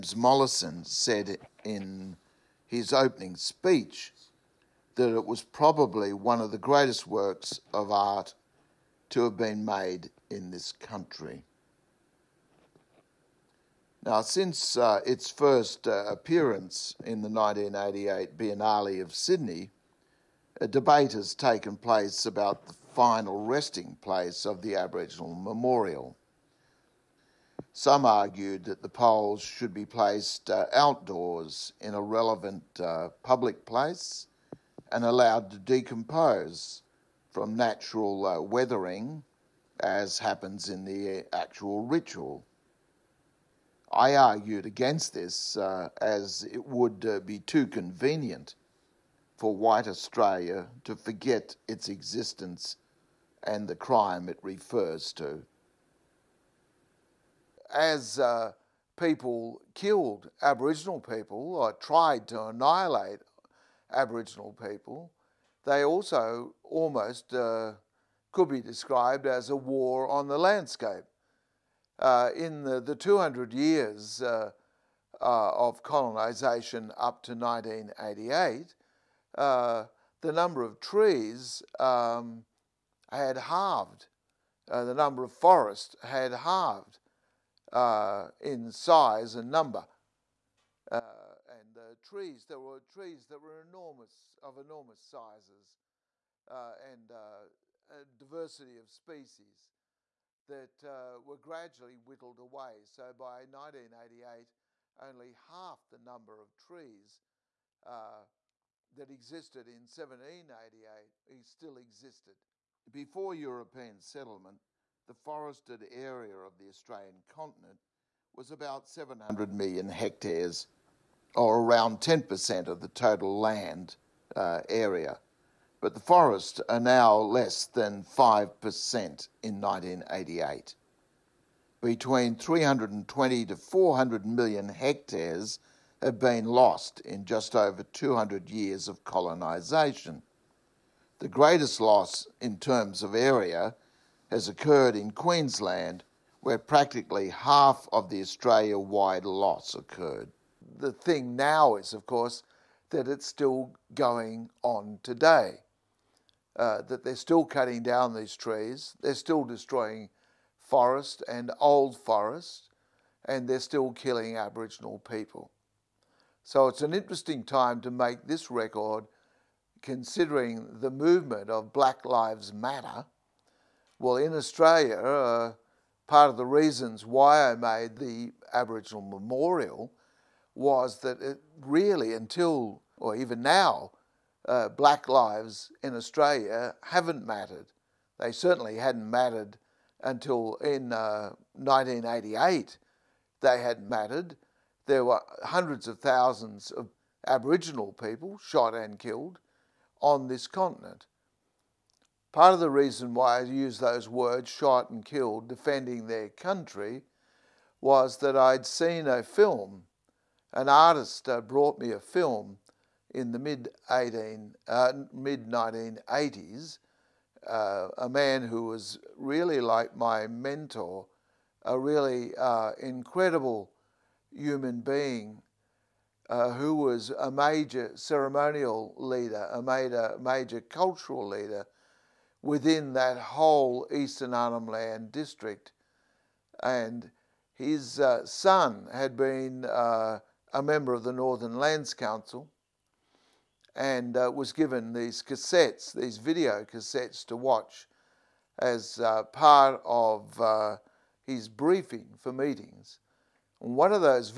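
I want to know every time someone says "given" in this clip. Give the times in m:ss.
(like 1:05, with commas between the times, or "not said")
4:04.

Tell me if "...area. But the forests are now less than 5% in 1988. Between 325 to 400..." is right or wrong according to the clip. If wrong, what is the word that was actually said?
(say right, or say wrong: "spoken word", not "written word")
wrong: "320", not "325".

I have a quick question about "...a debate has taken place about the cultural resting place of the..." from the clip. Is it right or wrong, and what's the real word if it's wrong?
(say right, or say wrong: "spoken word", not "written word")
wrong: "final", not "cultural".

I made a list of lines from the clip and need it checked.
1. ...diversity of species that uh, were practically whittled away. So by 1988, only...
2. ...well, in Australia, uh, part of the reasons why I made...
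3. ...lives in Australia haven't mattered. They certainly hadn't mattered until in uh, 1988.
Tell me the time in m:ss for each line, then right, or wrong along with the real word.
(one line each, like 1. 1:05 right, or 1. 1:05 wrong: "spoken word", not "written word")
1. 1:38 wrong: "gradually", not "practically"
2. 2:54 right
3. 3:05 right.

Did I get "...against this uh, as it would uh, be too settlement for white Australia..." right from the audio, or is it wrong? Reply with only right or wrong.
wrong.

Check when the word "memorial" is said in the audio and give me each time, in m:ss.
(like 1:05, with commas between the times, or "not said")
0:25, 2:59.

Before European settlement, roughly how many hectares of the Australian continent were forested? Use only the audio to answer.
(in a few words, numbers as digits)
700 million hectares.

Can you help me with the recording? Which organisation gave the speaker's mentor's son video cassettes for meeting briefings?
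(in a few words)
Northern Lands Council.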